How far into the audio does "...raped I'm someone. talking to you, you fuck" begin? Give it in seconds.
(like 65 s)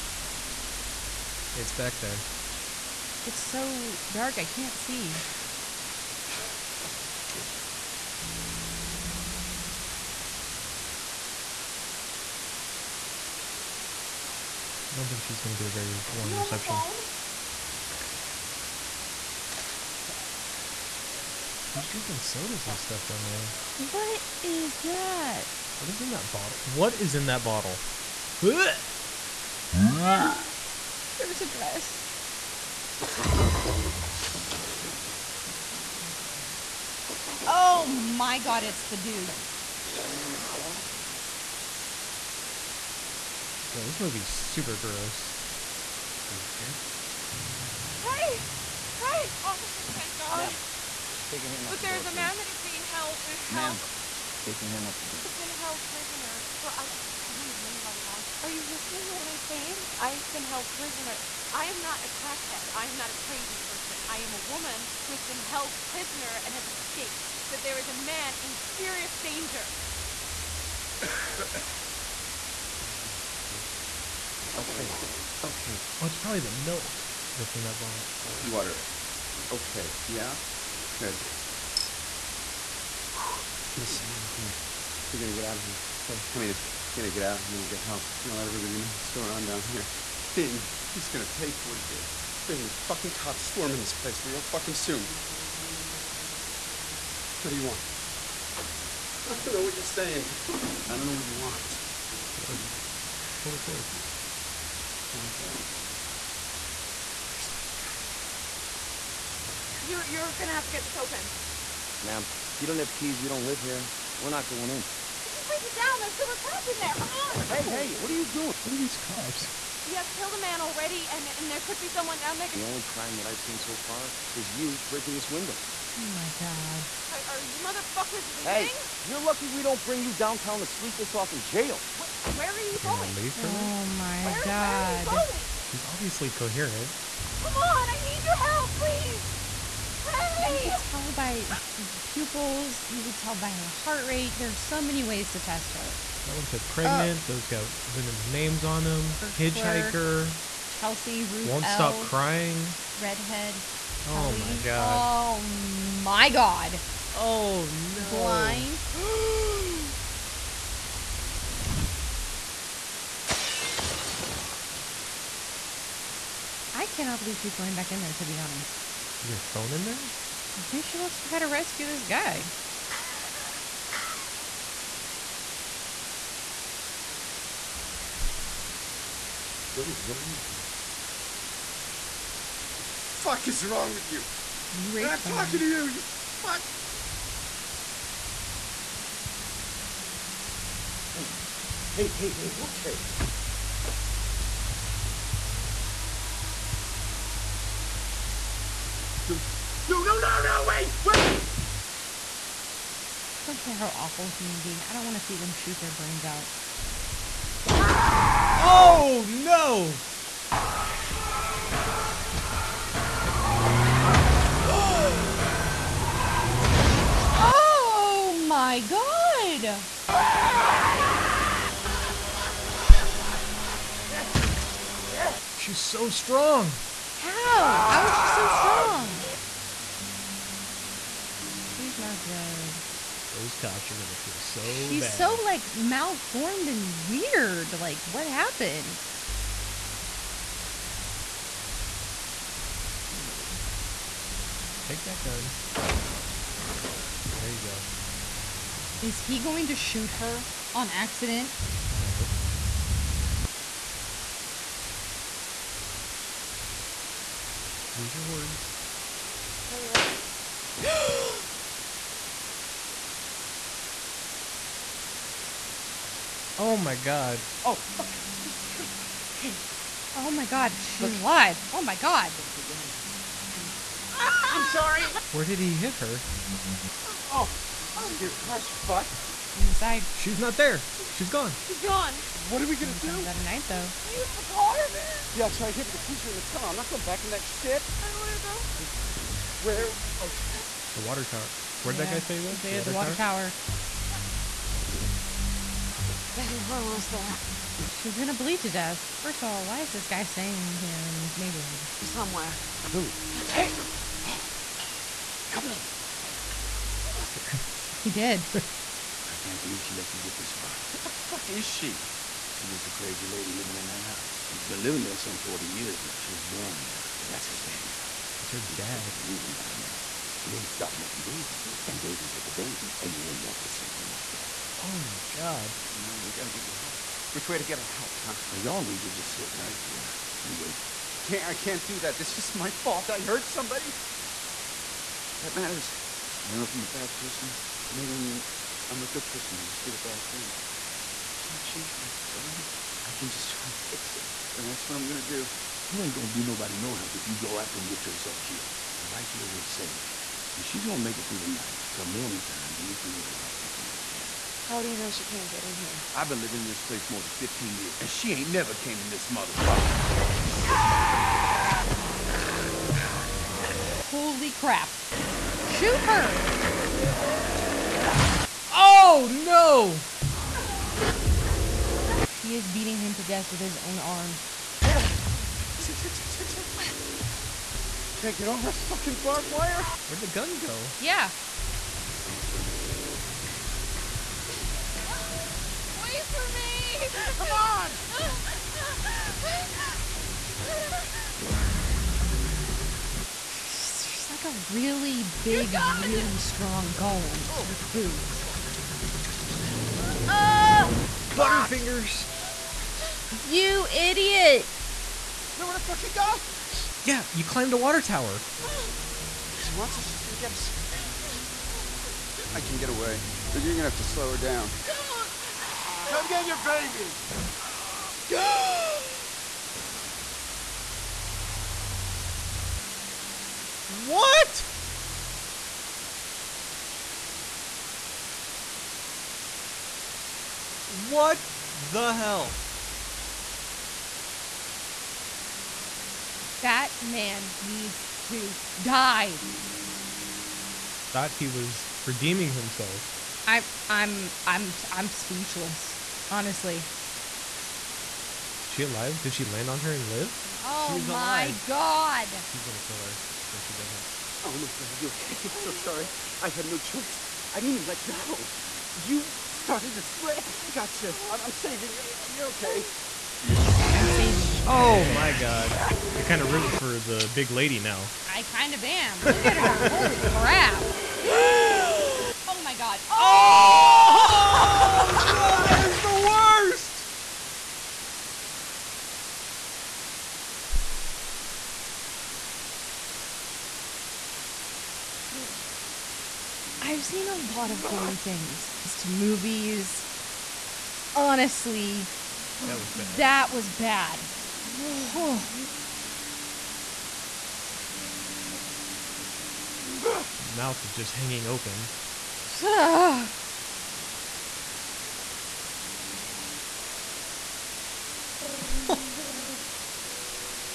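184 s.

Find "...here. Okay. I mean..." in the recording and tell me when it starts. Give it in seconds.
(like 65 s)
85 s.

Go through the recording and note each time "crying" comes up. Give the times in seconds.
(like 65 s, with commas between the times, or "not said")
152 s.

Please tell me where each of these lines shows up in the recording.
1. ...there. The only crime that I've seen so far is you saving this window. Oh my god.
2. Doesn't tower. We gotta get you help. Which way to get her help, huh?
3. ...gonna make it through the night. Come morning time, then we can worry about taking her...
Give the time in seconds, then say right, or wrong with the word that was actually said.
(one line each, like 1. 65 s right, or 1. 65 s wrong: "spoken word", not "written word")
1. 122 s wrong: "breaking", not "saving"
2. 325 s wrong: "matter", not "tower"
3. 350 s right.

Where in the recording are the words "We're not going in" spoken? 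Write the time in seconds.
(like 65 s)
114 s.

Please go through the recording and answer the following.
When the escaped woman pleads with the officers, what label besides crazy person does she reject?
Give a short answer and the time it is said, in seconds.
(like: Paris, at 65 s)
a crackhead, at 62 s.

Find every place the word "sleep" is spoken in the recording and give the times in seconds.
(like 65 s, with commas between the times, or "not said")
130 s.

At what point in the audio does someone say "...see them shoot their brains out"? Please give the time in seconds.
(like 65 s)
205 s.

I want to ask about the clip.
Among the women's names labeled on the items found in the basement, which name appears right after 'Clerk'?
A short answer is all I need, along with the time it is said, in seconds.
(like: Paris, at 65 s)
Chelsea, at 150 s.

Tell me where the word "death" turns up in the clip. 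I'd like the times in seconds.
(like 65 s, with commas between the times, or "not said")
298 s, 373 s.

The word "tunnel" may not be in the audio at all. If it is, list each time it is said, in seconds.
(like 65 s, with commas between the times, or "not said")
286 s.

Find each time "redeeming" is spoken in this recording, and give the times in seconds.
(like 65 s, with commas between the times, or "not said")
442 s.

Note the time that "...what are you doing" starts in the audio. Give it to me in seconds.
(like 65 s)
117 s.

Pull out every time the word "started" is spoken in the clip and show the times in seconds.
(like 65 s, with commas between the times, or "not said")
320 s, 459 s.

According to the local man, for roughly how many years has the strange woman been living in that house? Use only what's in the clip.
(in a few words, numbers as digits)
40.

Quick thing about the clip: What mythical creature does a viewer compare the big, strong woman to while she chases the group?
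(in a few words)
golem.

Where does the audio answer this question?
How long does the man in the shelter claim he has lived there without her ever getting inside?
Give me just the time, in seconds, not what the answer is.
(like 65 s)
357 s.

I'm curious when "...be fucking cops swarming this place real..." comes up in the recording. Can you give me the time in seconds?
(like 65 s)
92 s.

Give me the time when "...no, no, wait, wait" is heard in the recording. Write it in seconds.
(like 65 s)
200 s.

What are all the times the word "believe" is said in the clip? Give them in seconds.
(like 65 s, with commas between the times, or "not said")
167 s, 309 s.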